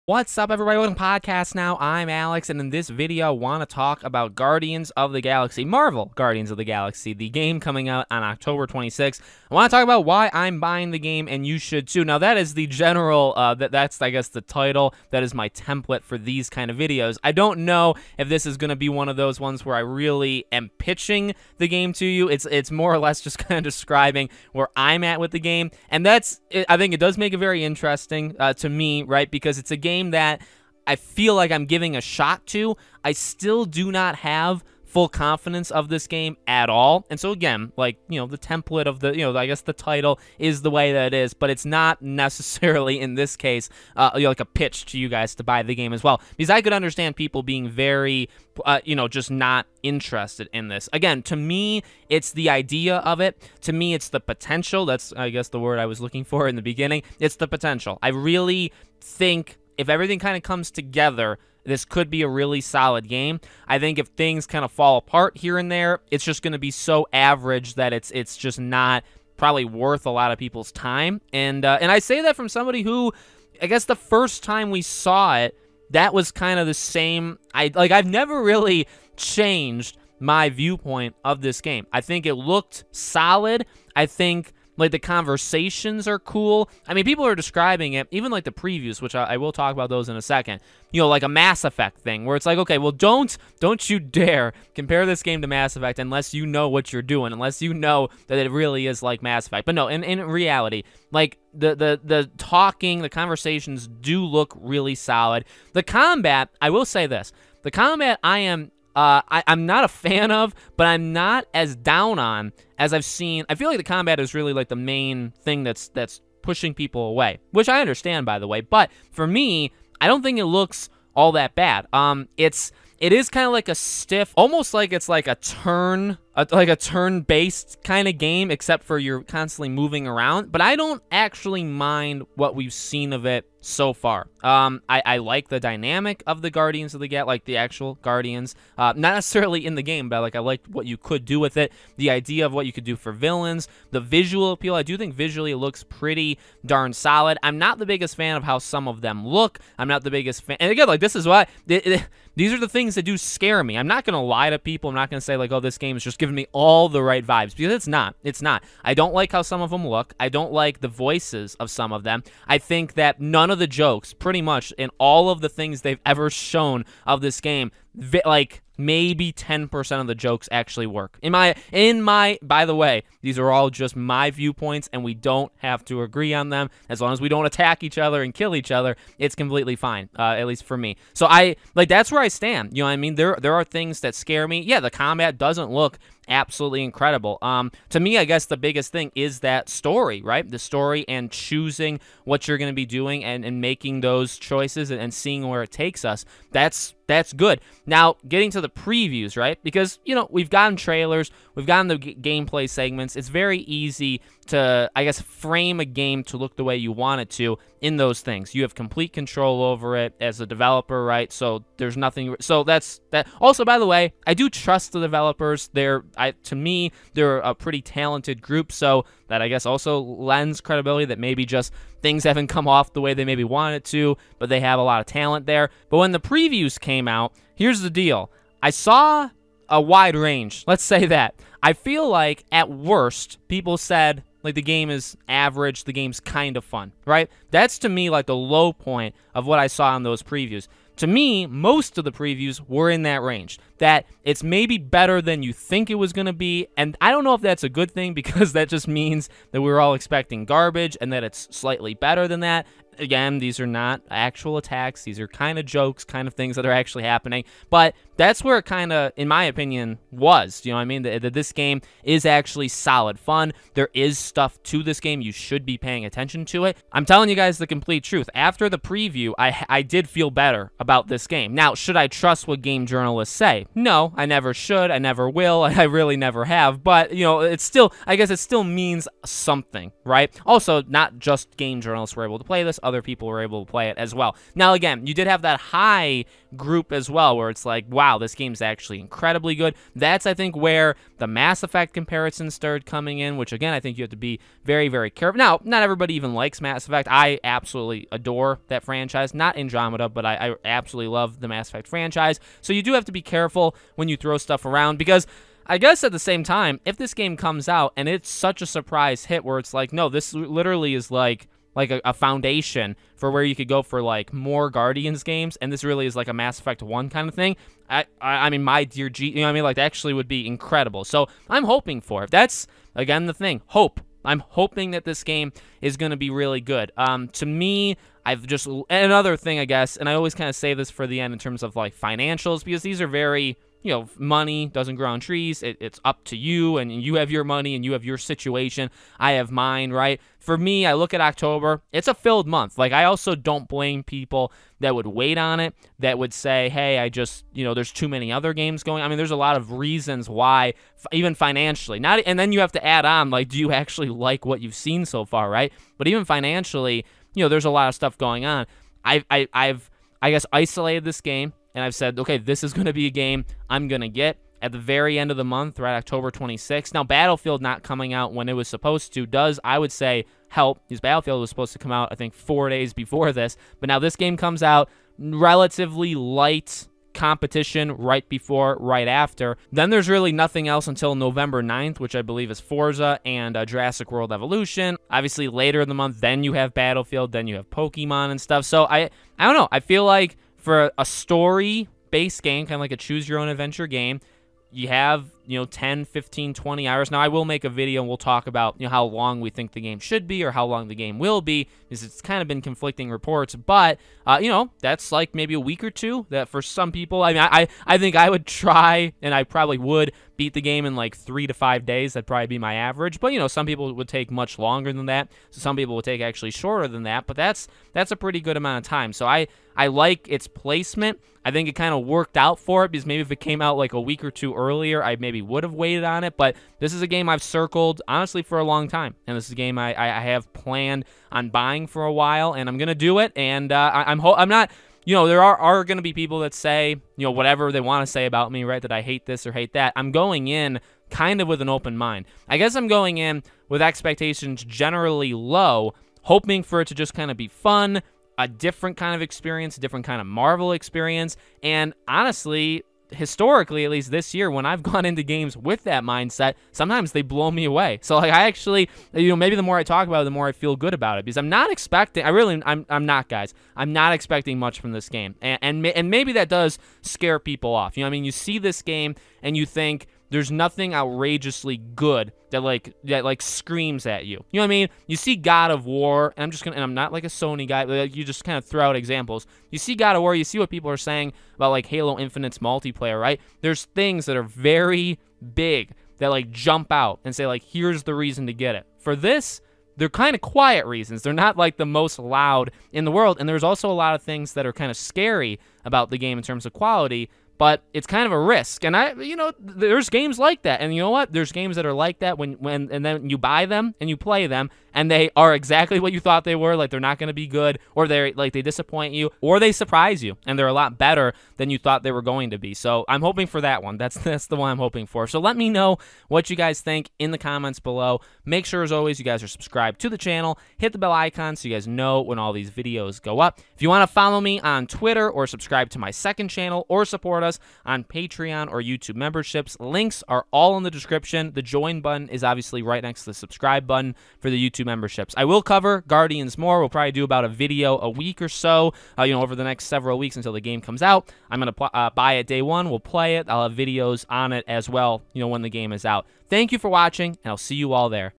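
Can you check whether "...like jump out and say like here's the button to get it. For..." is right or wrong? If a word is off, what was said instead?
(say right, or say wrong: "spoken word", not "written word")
wrong: "reason", not "button".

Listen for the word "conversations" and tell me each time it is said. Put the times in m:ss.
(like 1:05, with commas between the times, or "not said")
1:24, 1:43.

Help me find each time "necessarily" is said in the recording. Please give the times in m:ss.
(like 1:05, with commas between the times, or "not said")
0:42, 2:19.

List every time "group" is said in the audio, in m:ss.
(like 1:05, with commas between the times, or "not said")
3:38, 4:46.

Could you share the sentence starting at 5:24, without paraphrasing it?
I'm hoping that this game is going to be really good.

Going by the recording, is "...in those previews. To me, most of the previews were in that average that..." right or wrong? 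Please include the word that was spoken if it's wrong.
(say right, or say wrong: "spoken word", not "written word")
wrong: "range", not "average".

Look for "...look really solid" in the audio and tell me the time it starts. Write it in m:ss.
1:44.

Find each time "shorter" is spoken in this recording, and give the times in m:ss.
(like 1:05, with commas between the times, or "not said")
6:56.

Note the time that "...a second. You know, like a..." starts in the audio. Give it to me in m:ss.
1:30.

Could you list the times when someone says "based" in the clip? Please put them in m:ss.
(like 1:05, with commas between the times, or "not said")
2:06, 6:32.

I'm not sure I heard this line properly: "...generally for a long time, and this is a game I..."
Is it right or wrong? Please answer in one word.
wrong.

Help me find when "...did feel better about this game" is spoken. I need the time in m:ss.
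4:29.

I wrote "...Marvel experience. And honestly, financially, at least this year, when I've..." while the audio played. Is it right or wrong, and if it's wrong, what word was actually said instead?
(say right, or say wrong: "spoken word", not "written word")
wrong: "historically", not "financially".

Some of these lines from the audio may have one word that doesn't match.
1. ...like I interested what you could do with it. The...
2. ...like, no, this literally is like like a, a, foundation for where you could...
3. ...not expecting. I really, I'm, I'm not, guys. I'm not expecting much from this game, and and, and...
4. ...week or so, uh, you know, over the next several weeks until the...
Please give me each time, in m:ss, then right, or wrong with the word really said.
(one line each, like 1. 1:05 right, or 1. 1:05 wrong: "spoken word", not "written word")
1. 2:20 wrong: "liked", not "interested"
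2. 5:09 right
3. 7:41 right
4. 8:58 right.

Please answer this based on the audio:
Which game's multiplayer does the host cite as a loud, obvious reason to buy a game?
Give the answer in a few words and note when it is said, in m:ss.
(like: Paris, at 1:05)
Halo Infinite, at 8:01.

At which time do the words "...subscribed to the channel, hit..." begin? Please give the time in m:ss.
8:39.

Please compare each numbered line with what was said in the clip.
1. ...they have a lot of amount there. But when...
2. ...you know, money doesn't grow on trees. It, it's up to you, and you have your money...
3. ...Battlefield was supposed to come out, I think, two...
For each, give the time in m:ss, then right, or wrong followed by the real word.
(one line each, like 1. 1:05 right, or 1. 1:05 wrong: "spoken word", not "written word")
1. 3:44 wrong: "talent", not "amount"
2. 5:33 right
3. 6:11 wrong: "four", not "two".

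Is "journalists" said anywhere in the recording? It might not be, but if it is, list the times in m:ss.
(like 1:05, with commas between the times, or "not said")
4:32, 4:41.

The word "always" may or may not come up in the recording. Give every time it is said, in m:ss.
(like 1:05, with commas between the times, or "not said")
5:30, 8:38.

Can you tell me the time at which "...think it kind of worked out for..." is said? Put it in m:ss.
7:01.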